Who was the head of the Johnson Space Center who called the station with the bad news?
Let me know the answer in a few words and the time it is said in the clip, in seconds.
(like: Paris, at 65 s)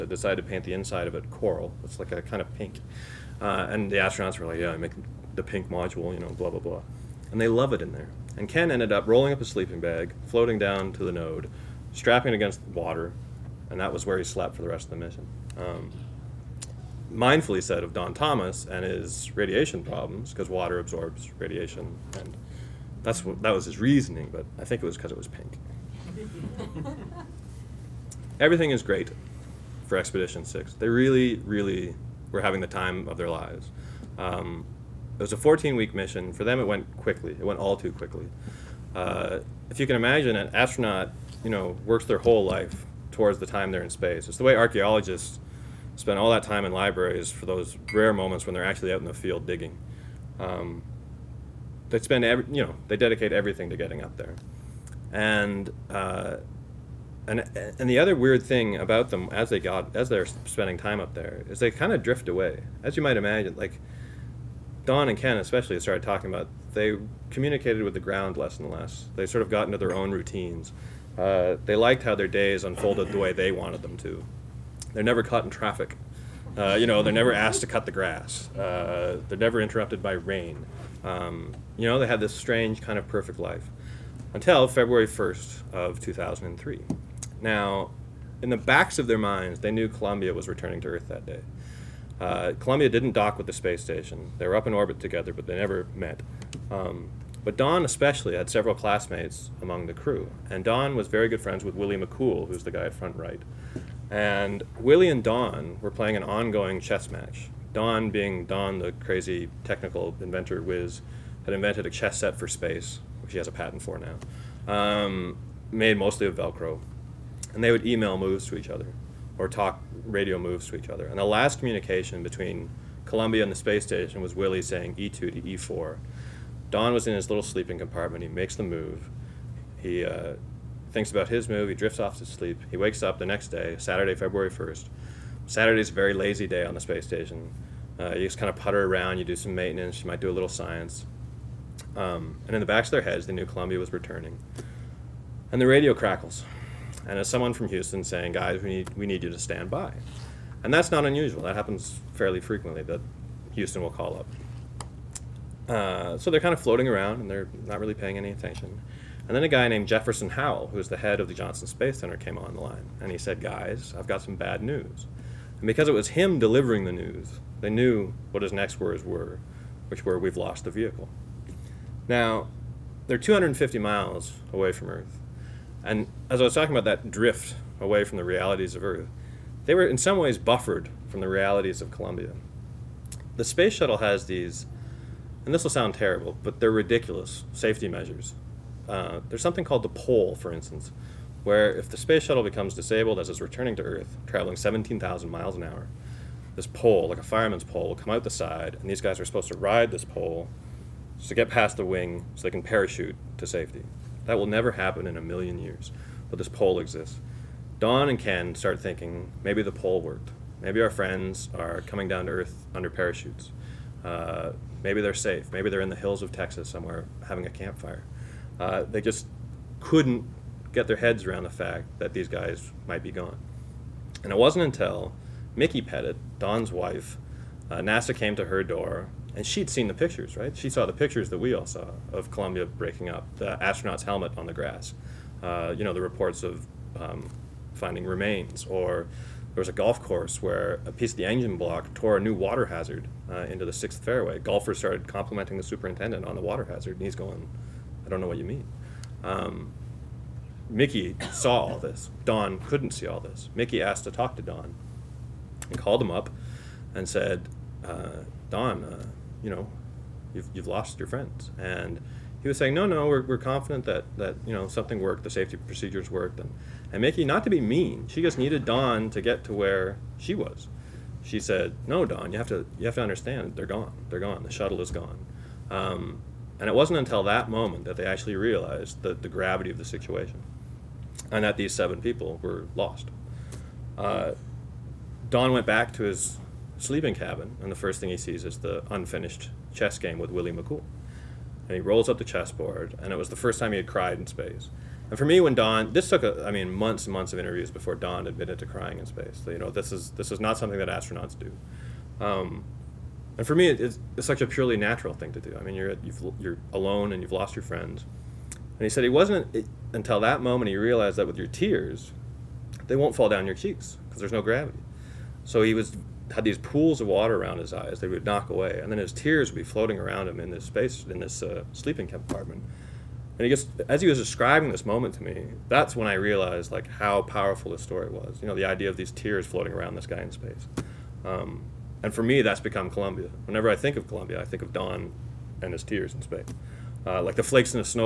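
Jefferson Howell, at 159 s.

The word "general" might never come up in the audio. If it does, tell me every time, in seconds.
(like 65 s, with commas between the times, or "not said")
not said.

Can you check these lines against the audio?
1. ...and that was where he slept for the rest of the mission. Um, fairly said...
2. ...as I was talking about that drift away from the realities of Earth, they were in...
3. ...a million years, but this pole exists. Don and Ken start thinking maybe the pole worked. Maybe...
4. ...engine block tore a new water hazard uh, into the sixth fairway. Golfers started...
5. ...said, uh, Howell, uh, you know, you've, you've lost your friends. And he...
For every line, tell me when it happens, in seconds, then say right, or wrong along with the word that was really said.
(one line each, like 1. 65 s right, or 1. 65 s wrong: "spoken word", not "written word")
1. 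13 s wrong: "mindfully", not "fairly"
2. 176 s right
3. 205 s right
4. 241 s right
5. 257 s wrong: "Don", not "Howell".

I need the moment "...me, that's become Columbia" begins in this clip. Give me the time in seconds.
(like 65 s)
332 s.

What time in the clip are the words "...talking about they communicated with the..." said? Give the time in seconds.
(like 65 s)
66 s.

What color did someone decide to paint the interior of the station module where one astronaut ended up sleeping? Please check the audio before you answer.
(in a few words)
Coral.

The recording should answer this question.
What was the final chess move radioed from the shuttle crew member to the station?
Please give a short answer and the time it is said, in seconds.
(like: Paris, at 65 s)
E2 to E4, at 124 s.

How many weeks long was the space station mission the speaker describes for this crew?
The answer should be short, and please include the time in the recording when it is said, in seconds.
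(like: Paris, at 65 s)
14, at 35 s.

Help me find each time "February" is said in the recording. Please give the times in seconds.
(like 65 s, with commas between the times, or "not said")
84 s, 134 s.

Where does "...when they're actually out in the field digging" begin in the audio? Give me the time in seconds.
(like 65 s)
48 s.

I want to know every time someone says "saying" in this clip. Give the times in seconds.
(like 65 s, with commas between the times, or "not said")
124 s, 148 s, 262 s.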